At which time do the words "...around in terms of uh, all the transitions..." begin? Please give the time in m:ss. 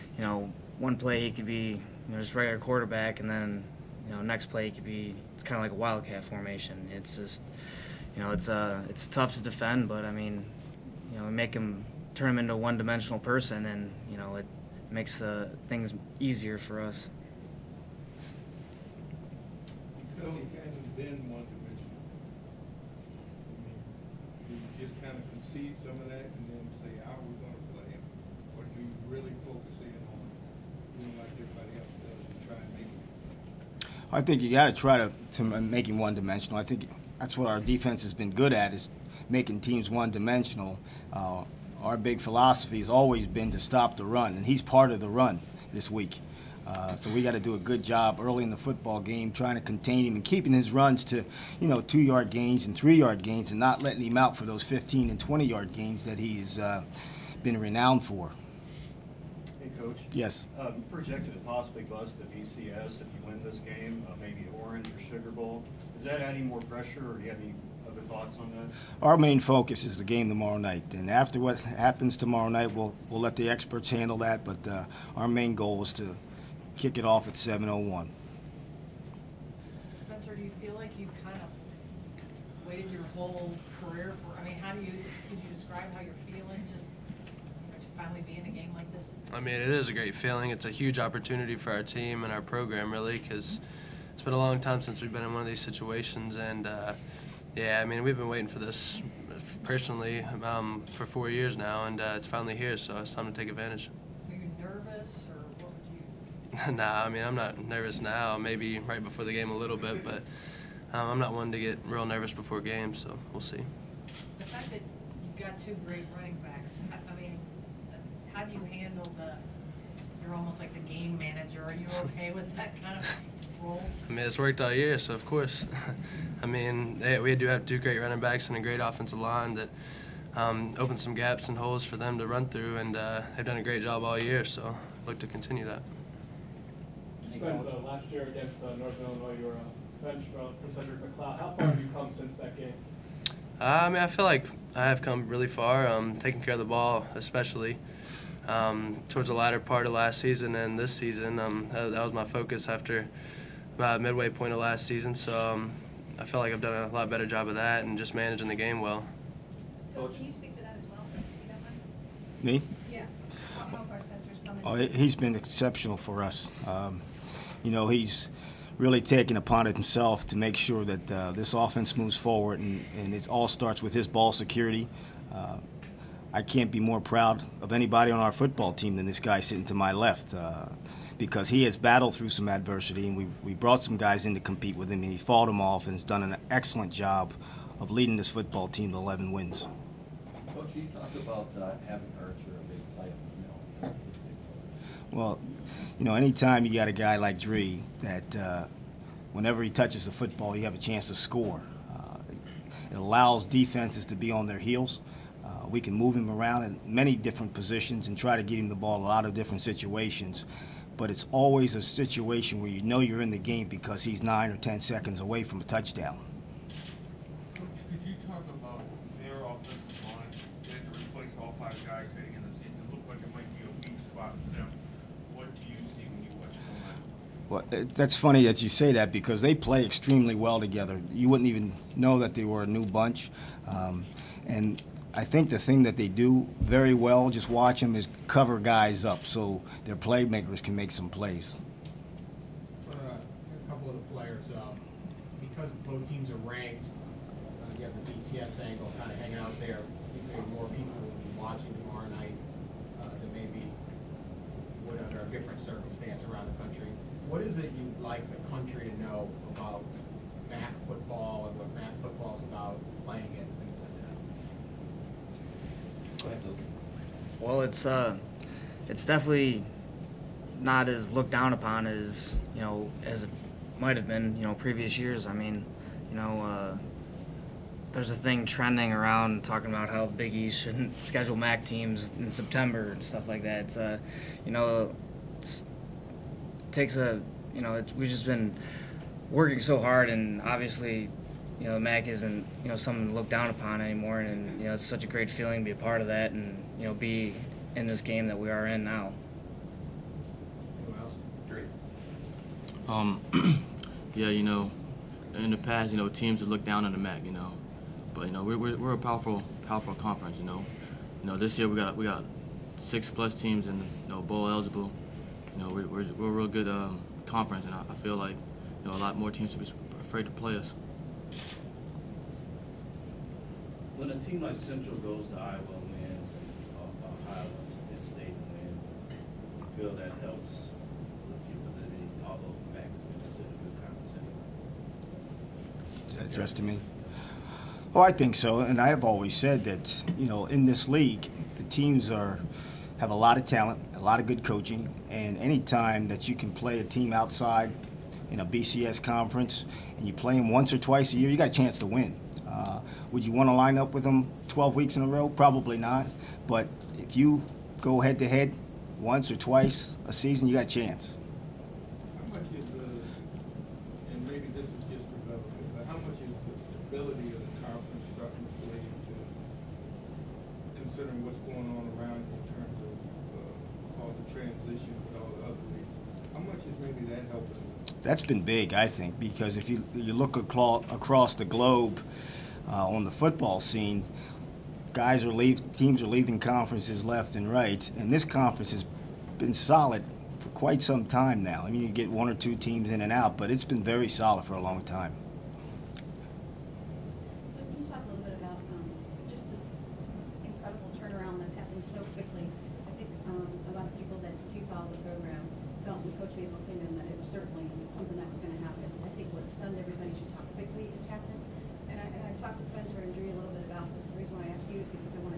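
6:12.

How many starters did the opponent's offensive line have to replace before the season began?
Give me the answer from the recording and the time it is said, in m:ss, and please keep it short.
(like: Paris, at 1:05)
5, at 3:41.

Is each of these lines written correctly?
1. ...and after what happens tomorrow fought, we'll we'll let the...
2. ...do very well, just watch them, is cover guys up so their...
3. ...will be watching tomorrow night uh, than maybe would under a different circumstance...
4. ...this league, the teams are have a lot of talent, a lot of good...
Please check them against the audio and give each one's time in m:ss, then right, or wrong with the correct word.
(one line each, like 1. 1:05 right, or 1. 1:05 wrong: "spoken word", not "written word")
1. 1:10 wrong: "night", not "fought"
2. 3:56 right
3. 4:11 right
4. 5:40 right.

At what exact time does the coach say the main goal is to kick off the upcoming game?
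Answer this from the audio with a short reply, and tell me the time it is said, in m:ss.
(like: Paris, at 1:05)
7:01, at 1:17.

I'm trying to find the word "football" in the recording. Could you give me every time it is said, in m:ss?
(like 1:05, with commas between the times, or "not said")
0:48, 2:58, 3:08, 3:20, 6:23.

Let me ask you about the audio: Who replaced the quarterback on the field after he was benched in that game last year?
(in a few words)
Cedric McCloud.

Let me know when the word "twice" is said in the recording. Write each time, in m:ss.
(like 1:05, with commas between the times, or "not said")
5:50, 5:59.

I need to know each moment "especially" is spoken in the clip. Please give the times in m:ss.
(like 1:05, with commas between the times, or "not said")
2:27.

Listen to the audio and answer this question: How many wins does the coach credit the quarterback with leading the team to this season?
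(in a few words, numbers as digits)
11.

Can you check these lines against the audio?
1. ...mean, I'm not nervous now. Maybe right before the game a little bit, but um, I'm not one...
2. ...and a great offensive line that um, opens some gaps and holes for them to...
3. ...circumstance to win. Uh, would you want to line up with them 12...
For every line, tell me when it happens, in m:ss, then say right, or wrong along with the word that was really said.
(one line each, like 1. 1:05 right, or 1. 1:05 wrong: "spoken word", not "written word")
1. 1:47 right
2. 2:08 right
3. 5:51 wrong: "chance", not "circumstance".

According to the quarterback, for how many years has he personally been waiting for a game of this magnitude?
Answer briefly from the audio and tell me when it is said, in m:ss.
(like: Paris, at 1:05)
4 years, at 1:41.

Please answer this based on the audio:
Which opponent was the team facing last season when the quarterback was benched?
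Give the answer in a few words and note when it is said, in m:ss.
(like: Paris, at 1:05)
Northern Illinois, at 2:18.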